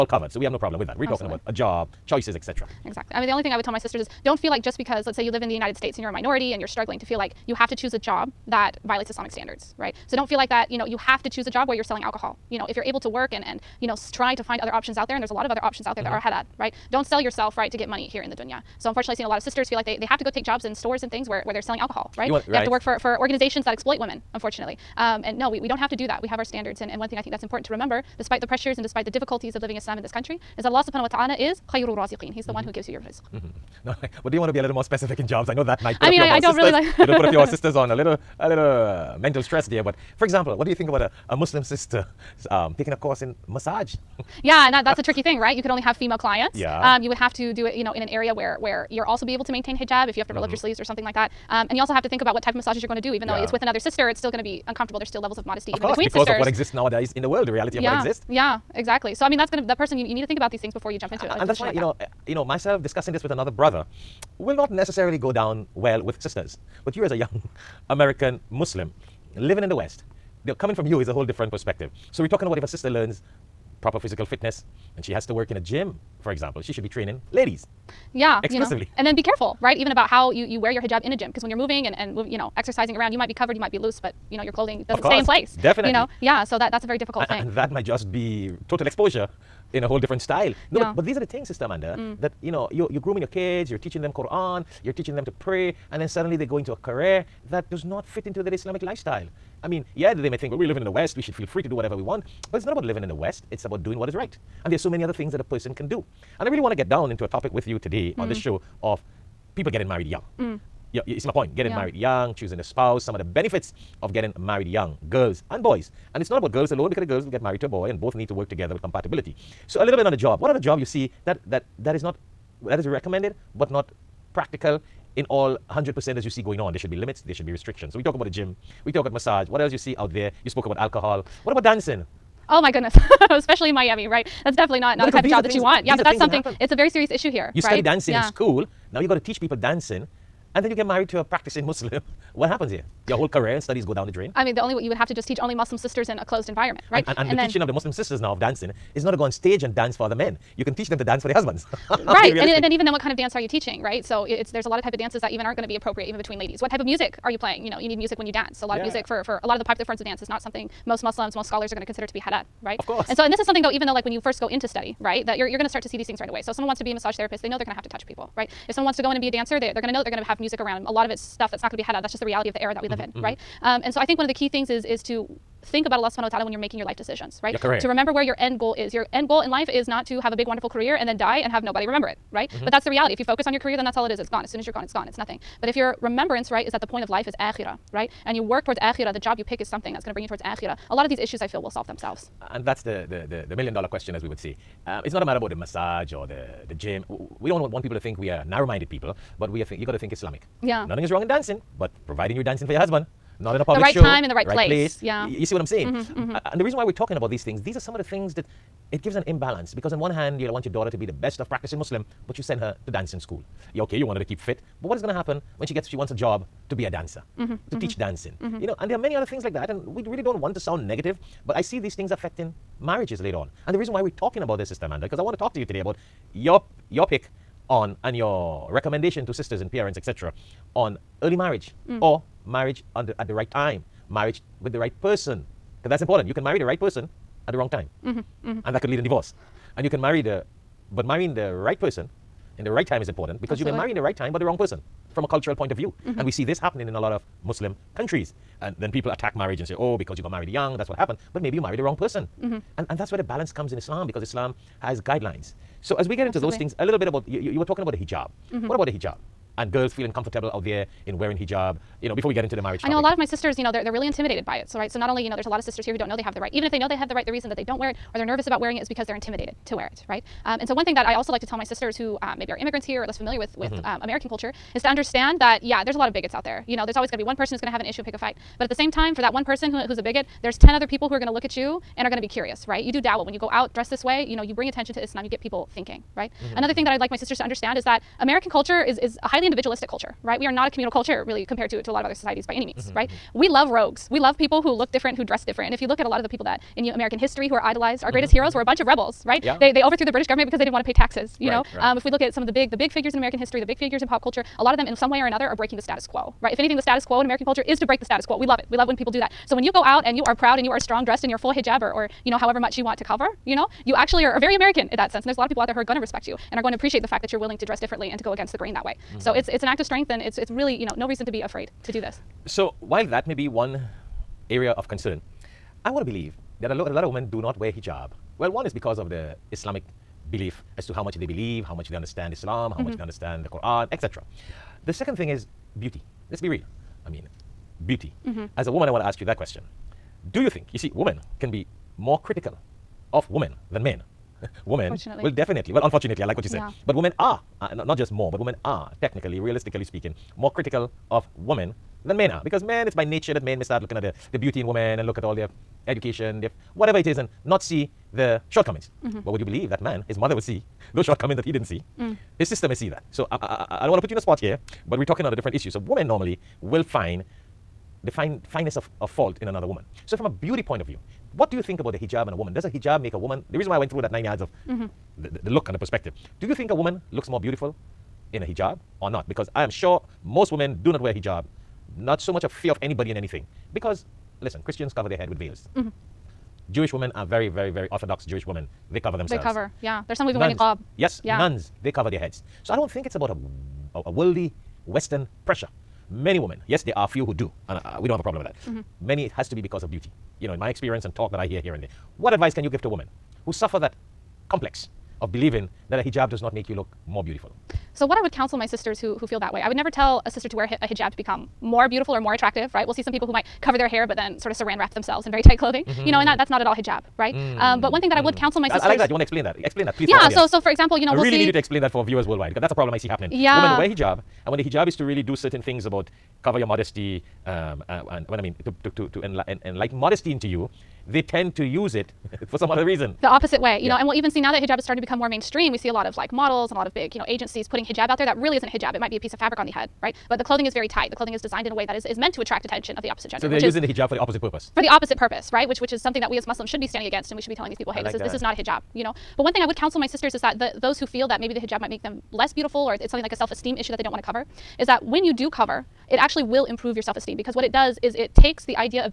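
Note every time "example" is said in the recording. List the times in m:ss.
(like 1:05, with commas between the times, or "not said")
0:40, 1:16, 7:00.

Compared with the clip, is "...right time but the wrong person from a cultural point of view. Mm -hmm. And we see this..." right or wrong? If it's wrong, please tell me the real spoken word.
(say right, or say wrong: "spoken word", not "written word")
right.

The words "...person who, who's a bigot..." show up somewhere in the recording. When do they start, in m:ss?
4:39.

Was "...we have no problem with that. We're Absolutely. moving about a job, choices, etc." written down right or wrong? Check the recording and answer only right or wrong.
wrong.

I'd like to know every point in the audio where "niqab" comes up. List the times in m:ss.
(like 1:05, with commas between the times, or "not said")
6:30.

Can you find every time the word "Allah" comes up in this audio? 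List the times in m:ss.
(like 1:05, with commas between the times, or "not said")
0:30, 2:55.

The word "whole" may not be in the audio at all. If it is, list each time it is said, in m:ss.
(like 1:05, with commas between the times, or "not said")
1:11, 1:29, 2:23.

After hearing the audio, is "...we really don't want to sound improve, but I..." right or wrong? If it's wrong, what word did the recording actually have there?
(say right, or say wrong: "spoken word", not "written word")
wrong: "negative", not "improve".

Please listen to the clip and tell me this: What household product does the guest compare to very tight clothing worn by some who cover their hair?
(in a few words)
saran wrap.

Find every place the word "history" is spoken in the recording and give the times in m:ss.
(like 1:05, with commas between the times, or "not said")
4:57, 5:03.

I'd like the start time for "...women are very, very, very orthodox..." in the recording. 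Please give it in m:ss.
6:26.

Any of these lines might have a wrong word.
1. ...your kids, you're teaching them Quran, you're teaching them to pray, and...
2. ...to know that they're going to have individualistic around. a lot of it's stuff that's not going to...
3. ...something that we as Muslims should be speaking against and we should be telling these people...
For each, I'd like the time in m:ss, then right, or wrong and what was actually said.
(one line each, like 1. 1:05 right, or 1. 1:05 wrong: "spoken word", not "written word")
1. 1:33 right
2. 2:49 wrong: "music", not "individualistic"
3. 7:26 wrong: "standing", not "speaking".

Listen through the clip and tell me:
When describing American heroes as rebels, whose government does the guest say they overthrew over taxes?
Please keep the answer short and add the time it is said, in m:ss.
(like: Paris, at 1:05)
the British government, at 5:00.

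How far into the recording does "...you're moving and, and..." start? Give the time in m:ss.
1:21.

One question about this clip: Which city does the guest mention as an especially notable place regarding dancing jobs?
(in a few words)
Miami.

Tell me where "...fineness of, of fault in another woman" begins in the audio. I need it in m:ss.
6:08.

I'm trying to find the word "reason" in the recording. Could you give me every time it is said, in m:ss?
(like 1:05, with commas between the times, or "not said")
3:26, 3:43, 4:27, 5:21, 6:13, 7:12.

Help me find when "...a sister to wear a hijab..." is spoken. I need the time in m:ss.
6:50.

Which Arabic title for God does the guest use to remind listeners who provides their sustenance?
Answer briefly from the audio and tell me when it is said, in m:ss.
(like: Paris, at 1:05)
khayru raziqeen, at 0:31.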